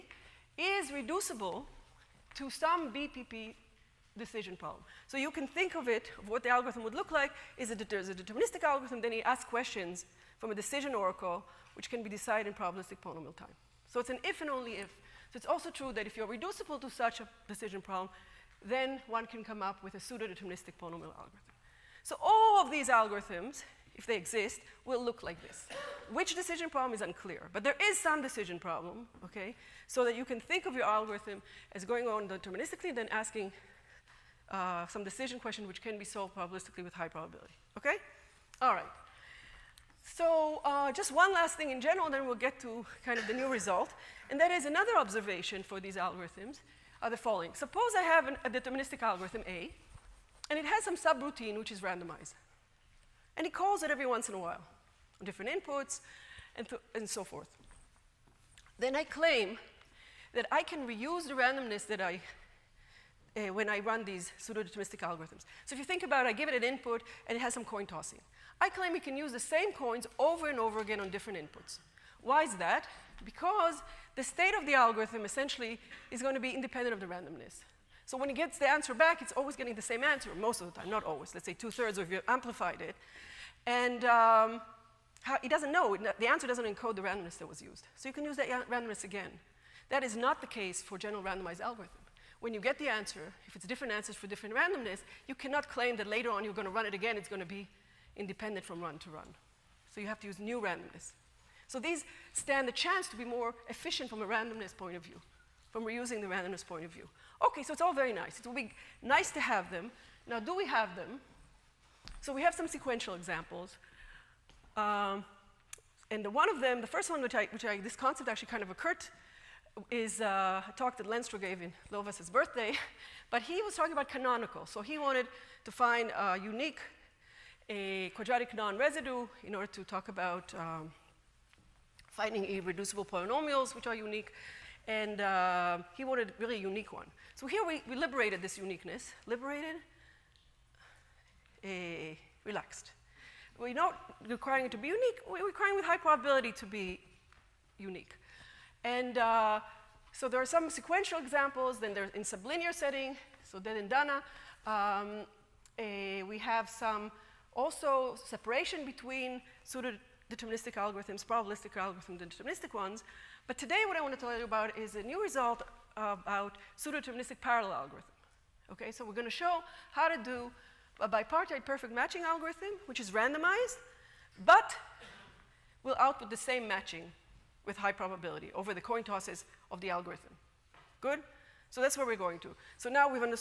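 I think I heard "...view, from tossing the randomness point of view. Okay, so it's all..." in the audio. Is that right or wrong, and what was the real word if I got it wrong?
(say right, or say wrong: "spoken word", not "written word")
wrong: "reusing", not "tossing".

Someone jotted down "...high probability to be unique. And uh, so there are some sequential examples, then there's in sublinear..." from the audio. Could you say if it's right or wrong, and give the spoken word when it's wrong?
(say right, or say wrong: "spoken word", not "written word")
right.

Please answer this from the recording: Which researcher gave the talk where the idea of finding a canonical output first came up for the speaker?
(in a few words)
Lenstra.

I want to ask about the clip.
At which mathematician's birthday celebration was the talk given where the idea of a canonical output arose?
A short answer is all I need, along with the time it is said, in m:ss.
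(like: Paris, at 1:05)
Lovász, at 2:01.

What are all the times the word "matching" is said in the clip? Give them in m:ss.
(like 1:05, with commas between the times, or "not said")
2:51, 2:56.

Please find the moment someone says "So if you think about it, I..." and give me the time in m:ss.
1:05.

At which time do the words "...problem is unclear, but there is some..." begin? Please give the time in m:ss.
0:26.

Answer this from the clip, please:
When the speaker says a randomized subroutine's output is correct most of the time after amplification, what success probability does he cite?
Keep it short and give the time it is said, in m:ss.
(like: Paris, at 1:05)
two-thirds, at 1:21.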